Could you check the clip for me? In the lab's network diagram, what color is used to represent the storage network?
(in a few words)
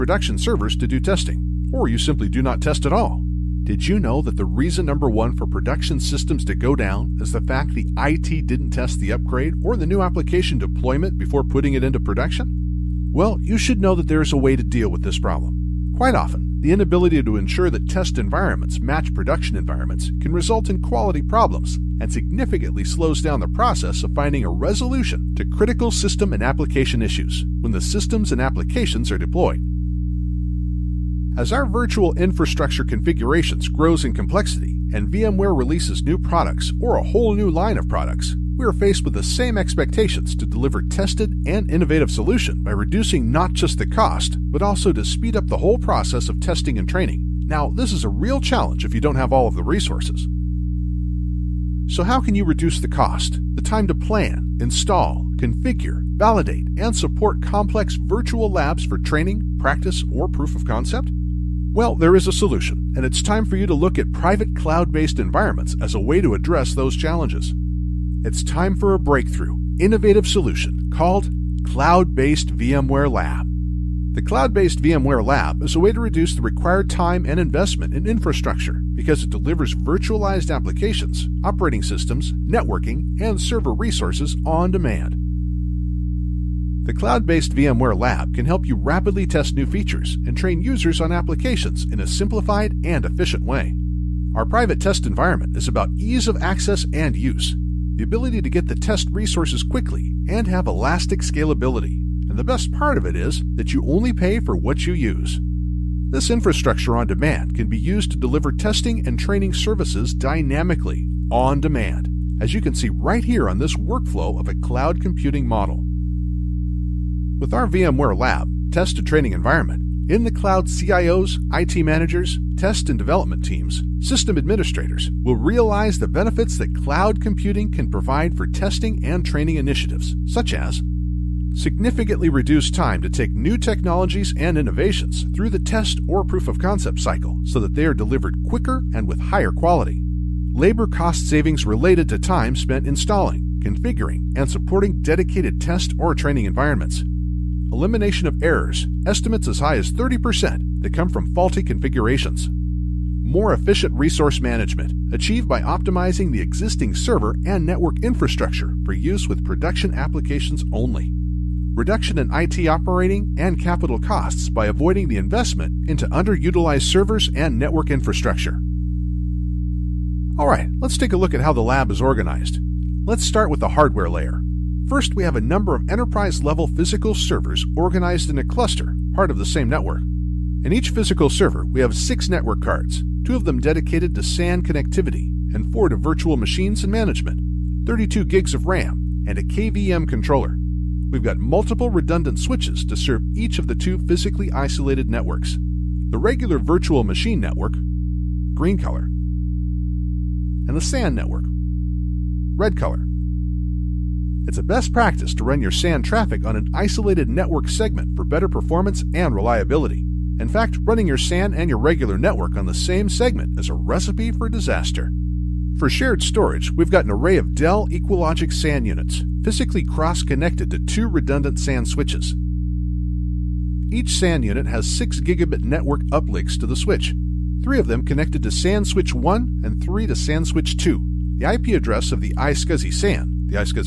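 Red.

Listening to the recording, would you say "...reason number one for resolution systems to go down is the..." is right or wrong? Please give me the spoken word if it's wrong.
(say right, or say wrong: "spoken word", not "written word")
wrong: "production", not "resolution".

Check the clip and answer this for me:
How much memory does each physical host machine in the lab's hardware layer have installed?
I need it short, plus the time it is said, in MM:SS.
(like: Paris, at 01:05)
32 GB, at 03:07.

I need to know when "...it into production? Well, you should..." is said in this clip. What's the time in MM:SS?
00:11.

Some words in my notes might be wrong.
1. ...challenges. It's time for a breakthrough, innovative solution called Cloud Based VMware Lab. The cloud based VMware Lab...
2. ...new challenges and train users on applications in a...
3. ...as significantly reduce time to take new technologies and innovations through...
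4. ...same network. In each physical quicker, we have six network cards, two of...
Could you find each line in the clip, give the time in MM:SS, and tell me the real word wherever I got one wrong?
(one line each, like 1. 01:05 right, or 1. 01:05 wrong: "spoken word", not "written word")
1. 01:06 right
2. 01:29 wrong: "features", not "challenges"
3. 02:10 right
4. 02:59 wrong: "server", not "quicker".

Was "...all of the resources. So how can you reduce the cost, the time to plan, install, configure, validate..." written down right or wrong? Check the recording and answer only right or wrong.
right.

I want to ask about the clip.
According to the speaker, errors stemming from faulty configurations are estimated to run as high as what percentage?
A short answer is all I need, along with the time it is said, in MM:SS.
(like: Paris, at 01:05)
30%, at 02:29.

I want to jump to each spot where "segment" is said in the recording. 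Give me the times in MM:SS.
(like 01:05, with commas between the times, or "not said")
03:27, 03:33.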